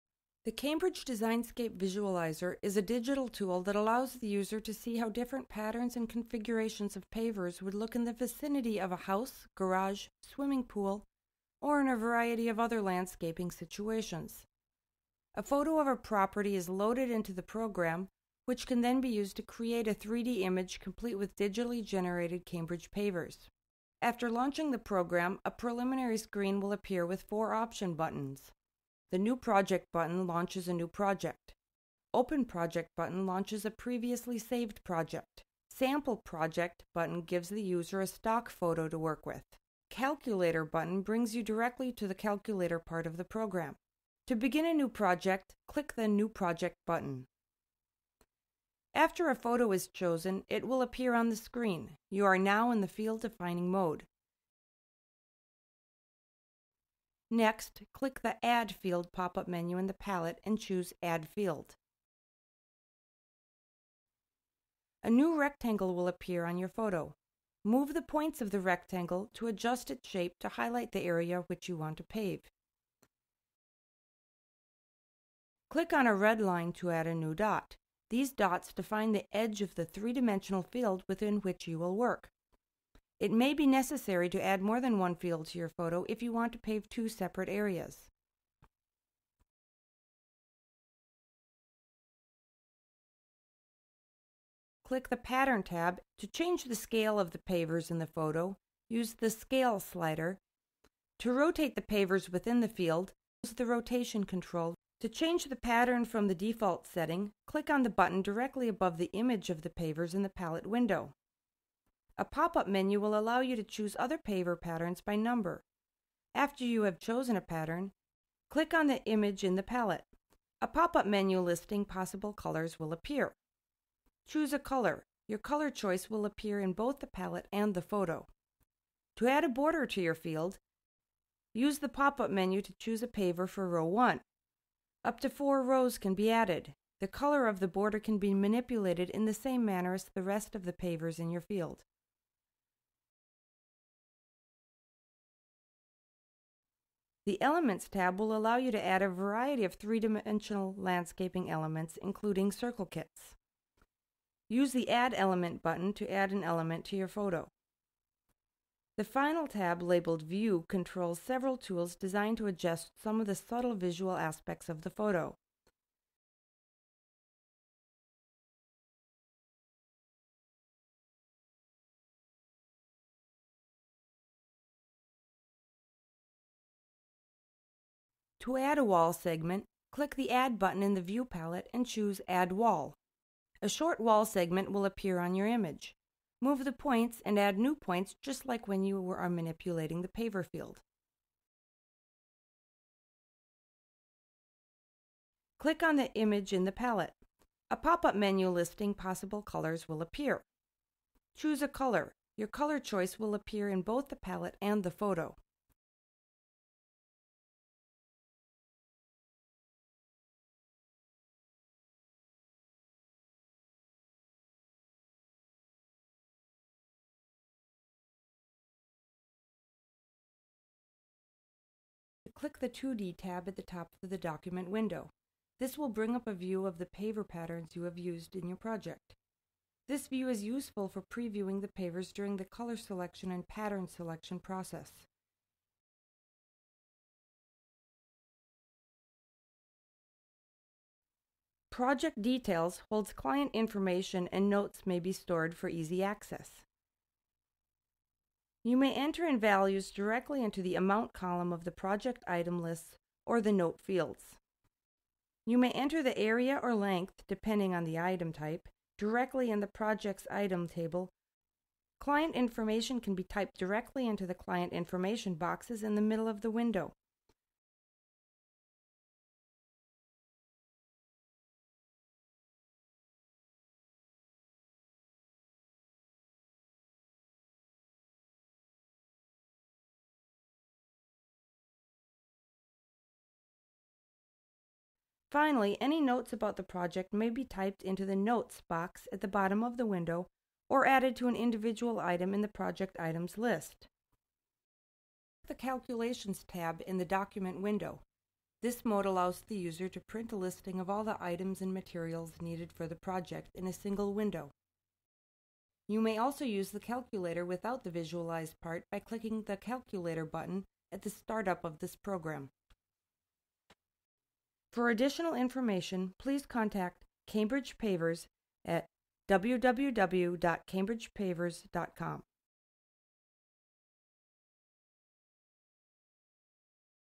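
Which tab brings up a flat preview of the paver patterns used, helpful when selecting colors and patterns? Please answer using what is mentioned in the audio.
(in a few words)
2D tab.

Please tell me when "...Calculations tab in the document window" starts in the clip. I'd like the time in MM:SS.
04:55.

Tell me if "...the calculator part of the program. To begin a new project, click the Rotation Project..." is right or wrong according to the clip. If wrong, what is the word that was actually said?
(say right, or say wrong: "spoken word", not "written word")
wrong: "New", not "Rotation".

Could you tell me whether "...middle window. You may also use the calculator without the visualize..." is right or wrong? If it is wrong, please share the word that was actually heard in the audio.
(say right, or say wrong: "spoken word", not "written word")
wrong: "single", not "middle".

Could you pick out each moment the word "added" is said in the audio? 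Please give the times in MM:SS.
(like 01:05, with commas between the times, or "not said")
02:16, 04:50.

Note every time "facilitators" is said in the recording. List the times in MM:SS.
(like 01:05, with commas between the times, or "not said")
not said.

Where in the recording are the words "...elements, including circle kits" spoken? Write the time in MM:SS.
02:31.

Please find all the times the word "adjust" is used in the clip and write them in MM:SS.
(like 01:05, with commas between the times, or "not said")
01:09, 02:42.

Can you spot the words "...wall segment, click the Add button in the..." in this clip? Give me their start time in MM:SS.
02:58.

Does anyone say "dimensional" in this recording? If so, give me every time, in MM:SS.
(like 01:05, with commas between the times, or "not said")
01:19, 02:29.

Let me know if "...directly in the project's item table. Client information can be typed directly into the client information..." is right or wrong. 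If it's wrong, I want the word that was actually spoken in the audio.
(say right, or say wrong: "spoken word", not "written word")
right.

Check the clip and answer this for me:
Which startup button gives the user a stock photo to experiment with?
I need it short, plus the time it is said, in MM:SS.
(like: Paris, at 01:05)
Sample Project, at 00:35.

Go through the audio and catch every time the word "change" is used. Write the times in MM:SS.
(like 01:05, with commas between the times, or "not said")
01:36, 01:45.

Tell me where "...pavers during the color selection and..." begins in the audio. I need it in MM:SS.
03:51.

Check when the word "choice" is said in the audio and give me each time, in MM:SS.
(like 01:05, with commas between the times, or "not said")
02:05, 03:22.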